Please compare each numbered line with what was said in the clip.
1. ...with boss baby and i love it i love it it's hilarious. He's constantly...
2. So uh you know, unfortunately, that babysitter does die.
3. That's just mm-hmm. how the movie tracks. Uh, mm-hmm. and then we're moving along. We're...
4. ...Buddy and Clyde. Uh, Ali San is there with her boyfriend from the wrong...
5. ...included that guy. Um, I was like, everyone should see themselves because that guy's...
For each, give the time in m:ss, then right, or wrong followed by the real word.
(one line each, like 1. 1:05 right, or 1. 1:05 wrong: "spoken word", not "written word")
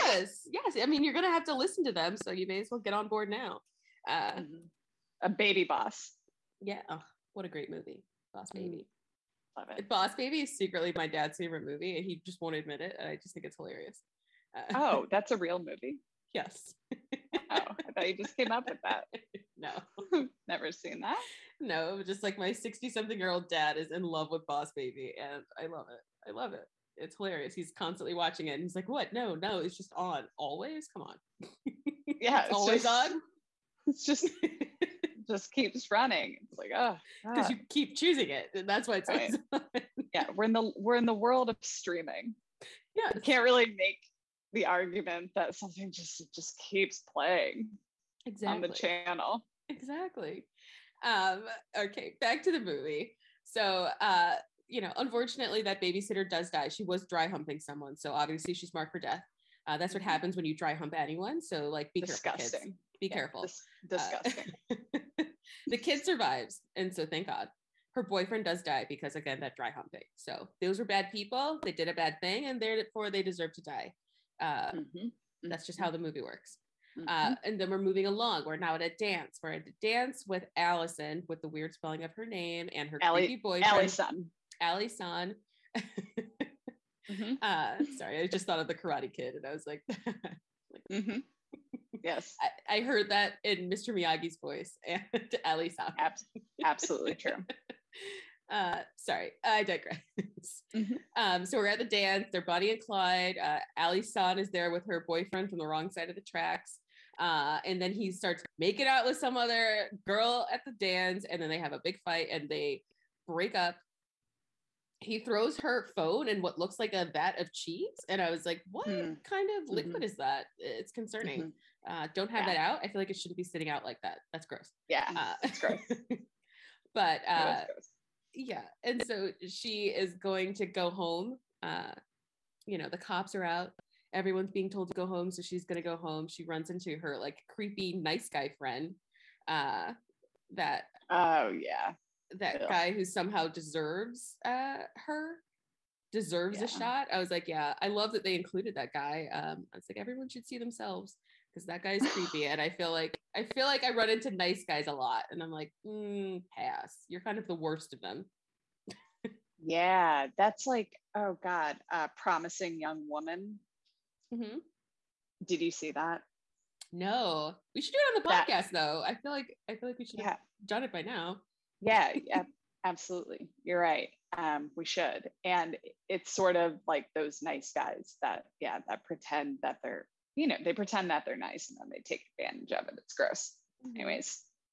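1. 0:24 right
2. 0:53 right
3. 1:15 wrong: "works", not "tracks"
4. 1:42 right
5. 2:28 right.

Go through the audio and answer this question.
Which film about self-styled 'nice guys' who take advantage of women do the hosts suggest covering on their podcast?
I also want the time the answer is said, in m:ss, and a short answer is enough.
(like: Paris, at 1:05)
Promising Young Woman, at 2:42.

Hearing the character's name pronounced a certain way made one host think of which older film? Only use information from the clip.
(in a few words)
The Karate Kid.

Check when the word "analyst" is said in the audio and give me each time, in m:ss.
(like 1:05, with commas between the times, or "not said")
not said.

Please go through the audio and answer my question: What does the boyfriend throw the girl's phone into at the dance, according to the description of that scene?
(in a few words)
A vat of cheese.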